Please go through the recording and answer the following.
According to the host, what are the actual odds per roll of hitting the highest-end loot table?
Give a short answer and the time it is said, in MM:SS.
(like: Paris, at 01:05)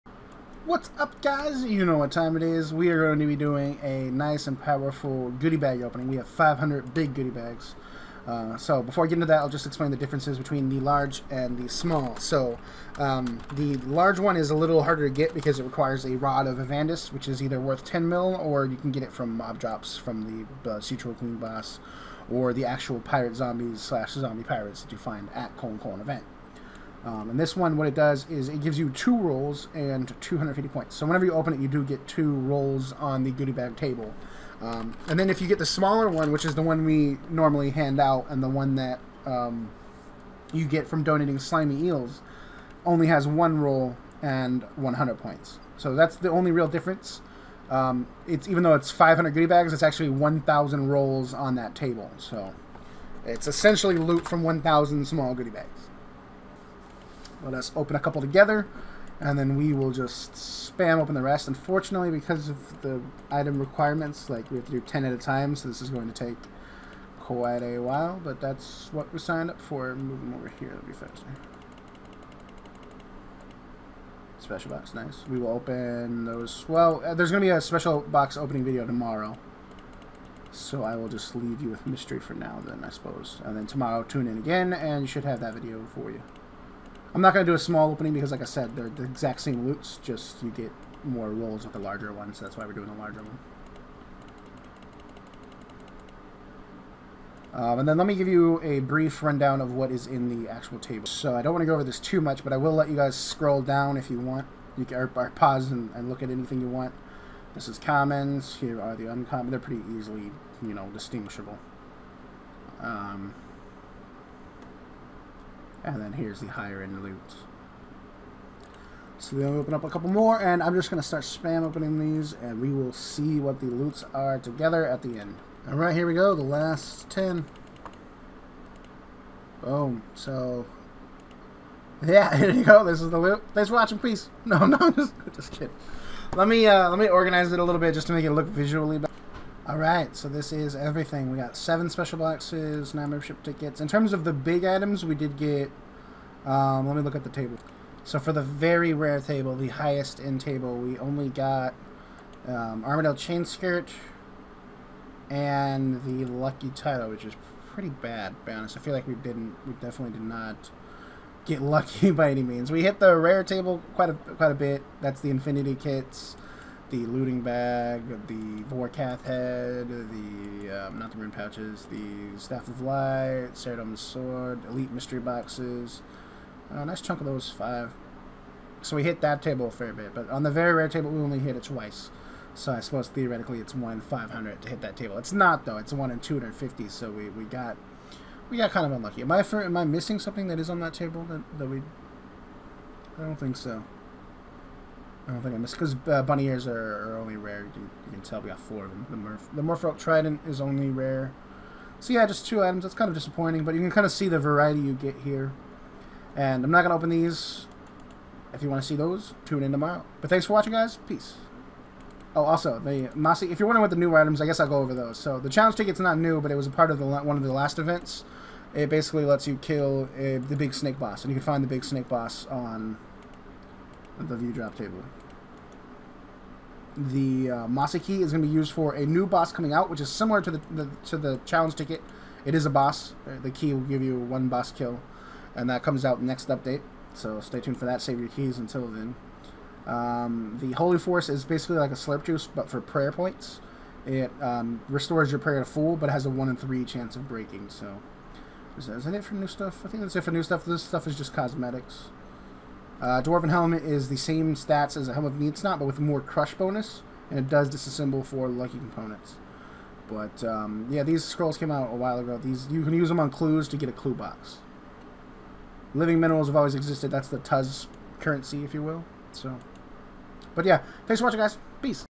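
1 in 250, at 03:05.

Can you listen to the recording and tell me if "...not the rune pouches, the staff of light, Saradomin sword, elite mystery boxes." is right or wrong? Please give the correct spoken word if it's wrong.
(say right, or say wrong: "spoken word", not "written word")
right.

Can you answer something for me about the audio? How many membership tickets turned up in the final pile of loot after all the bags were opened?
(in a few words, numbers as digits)
9.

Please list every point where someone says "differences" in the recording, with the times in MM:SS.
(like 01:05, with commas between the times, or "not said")
00:09, 00:46.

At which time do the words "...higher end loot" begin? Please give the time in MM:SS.
01:56.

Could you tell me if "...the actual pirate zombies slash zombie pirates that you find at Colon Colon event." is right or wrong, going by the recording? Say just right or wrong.
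right.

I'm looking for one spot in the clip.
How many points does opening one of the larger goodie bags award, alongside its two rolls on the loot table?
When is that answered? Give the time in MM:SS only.
00:30.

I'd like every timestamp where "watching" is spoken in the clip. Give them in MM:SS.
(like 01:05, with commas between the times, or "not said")
02:13, 03:30, 04:31.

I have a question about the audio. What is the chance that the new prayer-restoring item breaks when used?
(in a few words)
1 in 3.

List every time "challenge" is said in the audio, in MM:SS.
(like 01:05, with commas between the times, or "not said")
03:35, 03:51.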